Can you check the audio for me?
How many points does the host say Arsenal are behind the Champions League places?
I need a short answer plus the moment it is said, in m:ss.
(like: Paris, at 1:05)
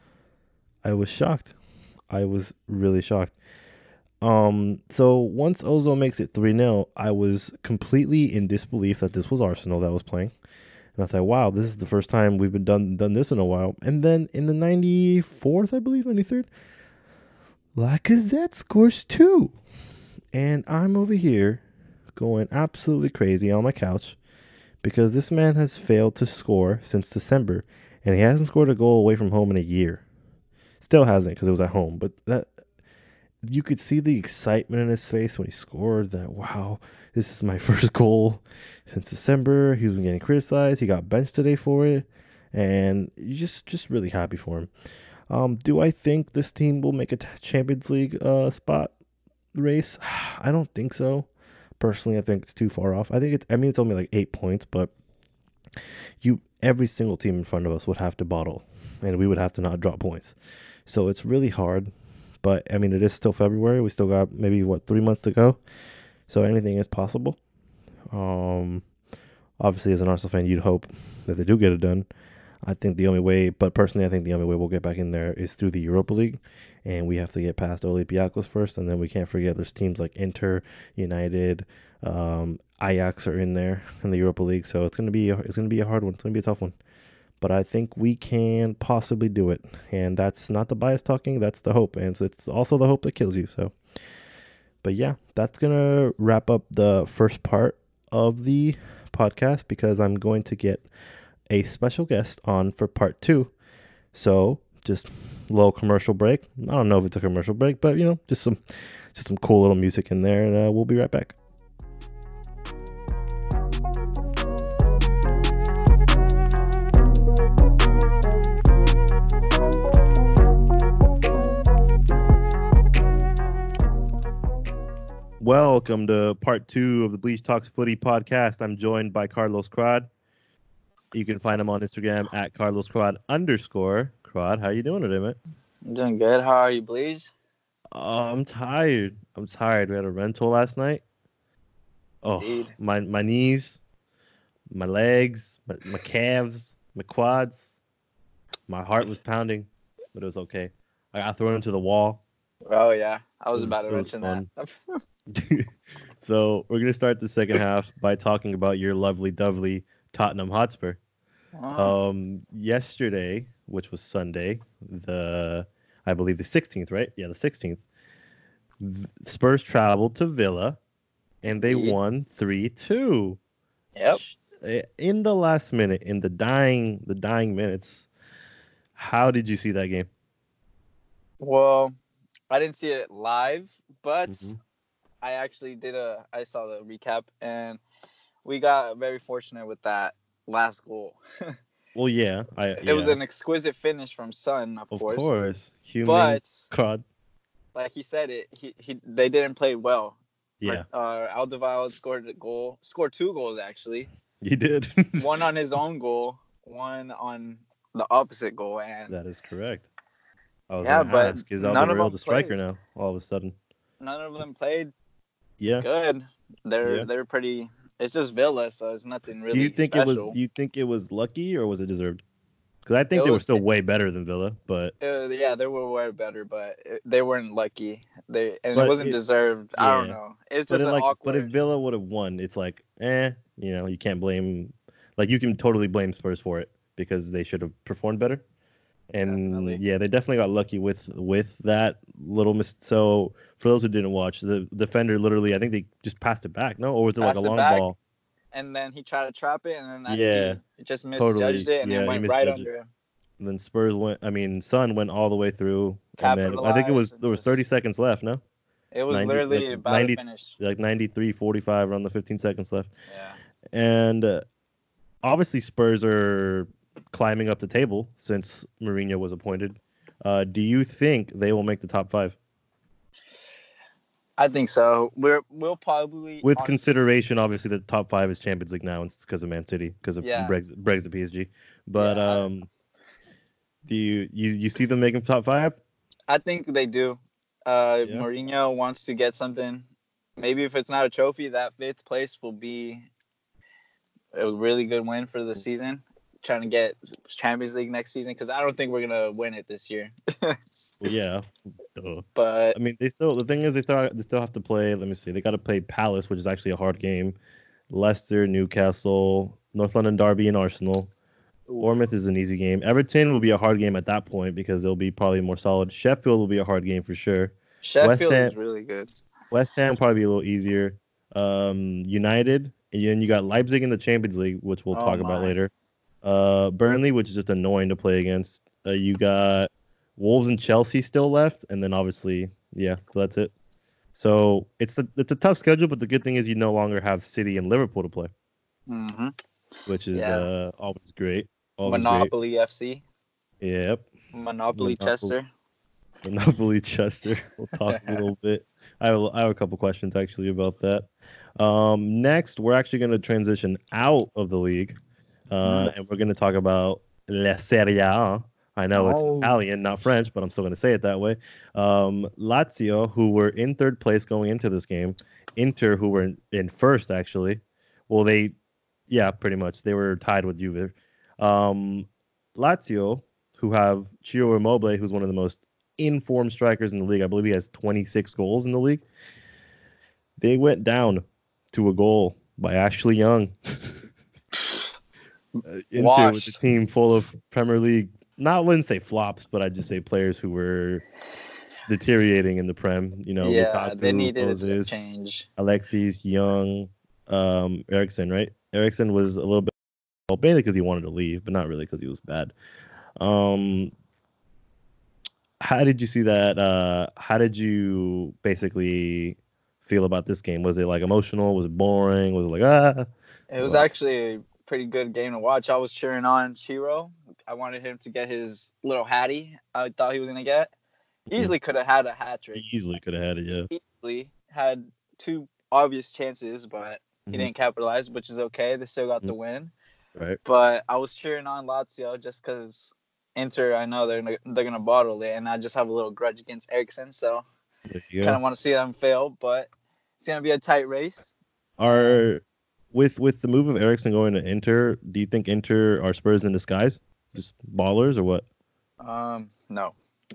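8, at 0:53.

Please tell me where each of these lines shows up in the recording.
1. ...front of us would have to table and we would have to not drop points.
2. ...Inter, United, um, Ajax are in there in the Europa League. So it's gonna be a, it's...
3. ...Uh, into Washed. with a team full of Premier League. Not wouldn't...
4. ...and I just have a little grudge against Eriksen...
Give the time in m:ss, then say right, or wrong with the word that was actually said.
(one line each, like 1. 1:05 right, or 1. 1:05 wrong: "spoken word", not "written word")
1. 0:57 wrong: "bottle", not "table"
2. 1:20 right
3. 6:25 right
4. 7:15 right.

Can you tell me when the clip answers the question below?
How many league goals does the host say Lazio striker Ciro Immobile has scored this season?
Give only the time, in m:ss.
6:17.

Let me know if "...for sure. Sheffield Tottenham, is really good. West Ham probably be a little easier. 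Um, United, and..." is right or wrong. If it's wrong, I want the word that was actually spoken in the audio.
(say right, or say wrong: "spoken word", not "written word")
wrong: "Ham", not "Tottenham".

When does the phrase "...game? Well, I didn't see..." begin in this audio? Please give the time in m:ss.
2:59.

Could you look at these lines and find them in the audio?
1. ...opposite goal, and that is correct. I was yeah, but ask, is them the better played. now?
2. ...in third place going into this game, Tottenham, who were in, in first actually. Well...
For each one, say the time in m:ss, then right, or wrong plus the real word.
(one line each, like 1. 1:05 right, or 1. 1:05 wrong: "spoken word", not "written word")
1. 3:28 wrong: "striker", not "better"
2. 6:03 wrong: "Inter", not "Tottenham".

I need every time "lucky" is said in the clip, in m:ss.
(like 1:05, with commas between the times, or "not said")
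3:41, 3:47, 4:00.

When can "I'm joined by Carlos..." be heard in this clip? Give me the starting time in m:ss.
2:08.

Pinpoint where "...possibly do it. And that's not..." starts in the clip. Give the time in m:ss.
1:28.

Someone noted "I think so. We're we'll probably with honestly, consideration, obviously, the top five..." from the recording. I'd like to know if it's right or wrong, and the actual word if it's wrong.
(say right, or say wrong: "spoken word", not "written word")
right.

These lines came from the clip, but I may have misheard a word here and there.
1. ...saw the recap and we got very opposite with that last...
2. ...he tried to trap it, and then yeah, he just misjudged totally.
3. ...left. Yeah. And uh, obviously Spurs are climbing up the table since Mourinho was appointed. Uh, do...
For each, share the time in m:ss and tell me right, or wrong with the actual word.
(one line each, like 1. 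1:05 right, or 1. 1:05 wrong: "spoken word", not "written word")
1. 3:06 wrong: "fortunate", not "opposite"
2. 4:08 right
3. 4:22 right.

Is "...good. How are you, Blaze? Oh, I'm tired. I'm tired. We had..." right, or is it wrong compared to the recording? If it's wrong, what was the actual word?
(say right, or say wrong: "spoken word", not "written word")
right.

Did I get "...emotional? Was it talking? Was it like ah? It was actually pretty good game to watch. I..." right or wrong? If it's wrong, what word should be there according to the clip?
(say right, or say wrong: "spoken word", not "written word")
wrong: "boring", not "talking".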